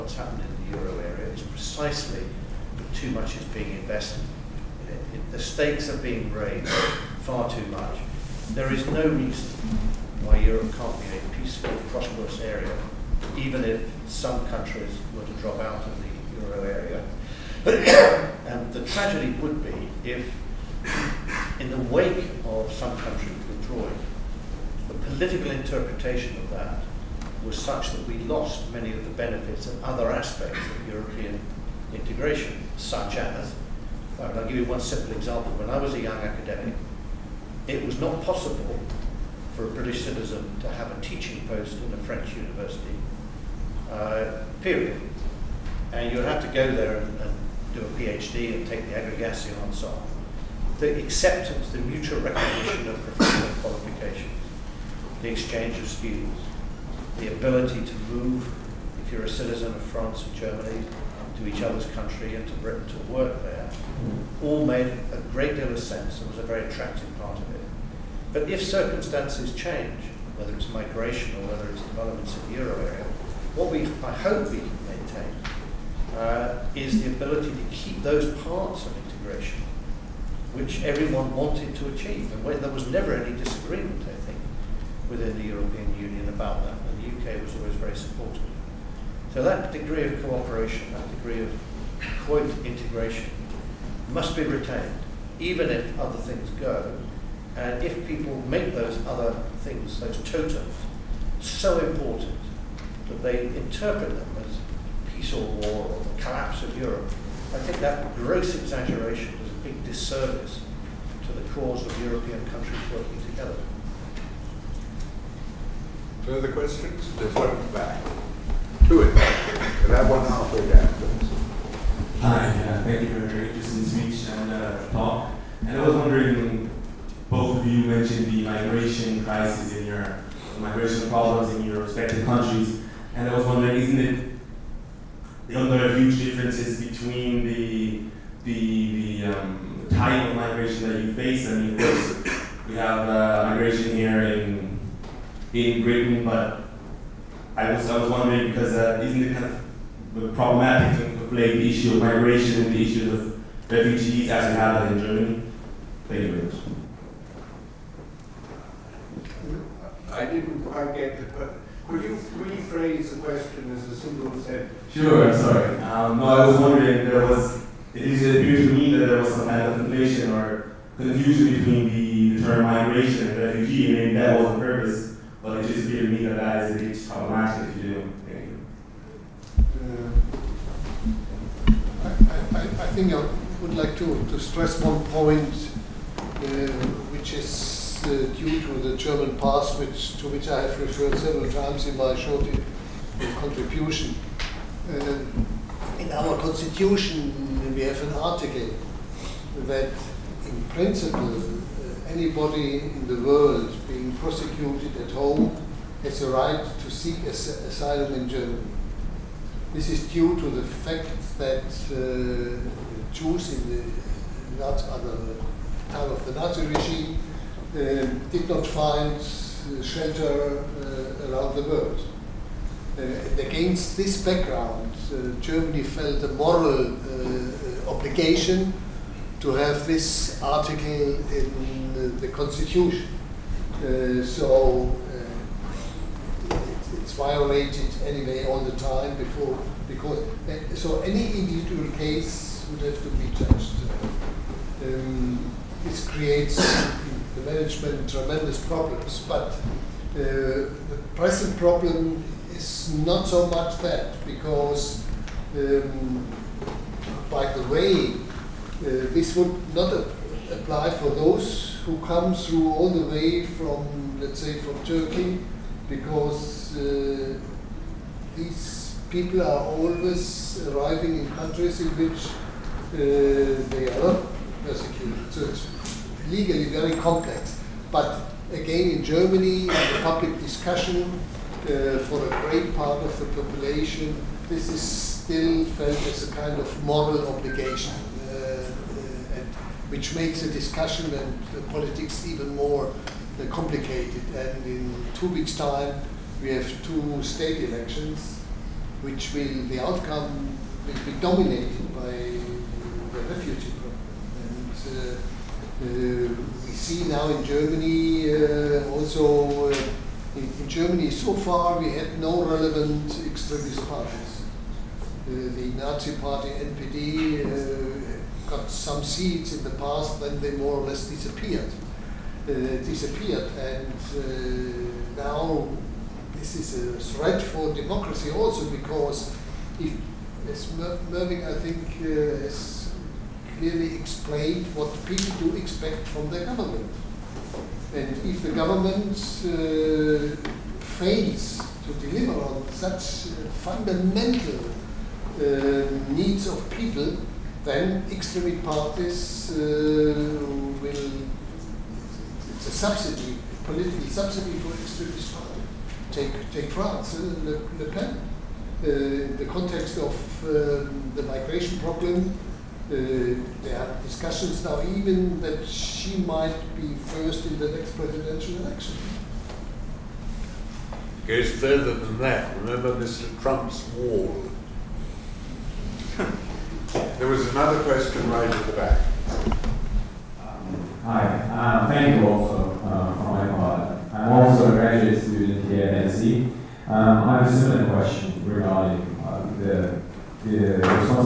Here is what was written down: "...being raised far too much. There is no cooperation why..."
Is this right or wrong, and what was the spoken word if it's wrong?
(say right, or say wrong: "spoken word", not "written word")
wrong: "reason", not "cooperation".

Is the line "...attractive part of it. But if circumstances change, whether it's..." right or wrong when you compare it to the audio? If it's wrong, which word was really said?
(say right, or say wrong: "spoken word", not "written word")
right.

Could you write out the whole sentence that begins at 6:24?
I'm also a graduate student here at NC.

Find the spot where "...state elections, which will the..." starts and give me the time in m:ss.
4:57.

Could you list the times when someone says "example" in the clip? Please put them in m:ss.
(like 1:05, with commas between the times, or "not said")
0:35.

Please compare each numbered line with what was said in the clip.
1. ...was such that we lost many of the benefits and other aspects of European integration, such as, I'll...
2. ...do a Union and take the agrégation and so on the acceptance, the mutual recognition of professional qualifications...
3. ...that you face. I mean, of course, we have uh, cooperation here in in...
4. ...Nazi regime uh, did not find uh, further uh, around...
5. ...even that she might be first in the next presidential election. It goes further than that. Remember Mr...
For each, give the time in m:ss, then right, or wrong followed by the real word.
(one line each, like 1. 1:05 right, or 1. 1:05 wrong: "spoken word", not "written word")
1. 0:27 right
2. 0:47 wrong: "PhD", not "Union"
3. 2:20 wrong: "migration", not "cooperation"
4. 3:36 wrong: "shelter", not "further"
5. 6:04 right.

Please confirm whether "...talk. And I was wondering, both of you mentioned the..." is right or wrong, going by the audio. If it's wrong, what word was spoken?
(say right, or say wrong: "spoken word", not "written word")
right.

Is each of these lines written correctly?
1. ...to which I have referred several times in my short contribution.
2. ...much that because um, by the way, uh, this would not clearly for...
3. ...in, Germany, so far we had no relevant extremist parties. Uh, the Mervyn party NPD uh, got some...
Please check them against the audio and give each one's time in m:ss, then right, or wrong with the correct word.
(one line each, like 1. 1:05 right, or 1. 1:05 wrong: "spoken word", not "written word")
1. 3:10 right
2. 4:13 wrong: "apply", not "clearly"
3. 5:10 wrong: "Nazi", not "Mervyn".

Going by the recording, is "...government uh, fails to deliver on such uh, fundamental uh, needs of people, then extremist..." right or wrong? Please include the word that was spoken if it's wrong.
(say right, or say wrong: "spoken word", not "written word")
right.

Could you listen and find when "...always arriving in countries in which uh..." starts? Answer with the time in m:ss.
4:29.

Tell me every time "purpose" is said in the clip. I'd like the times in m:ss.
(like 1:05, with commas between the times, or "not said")
2:54.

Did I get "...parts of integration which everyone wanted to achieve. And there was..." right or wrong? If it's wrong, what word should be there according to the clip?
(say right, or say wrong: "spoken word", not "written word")
right.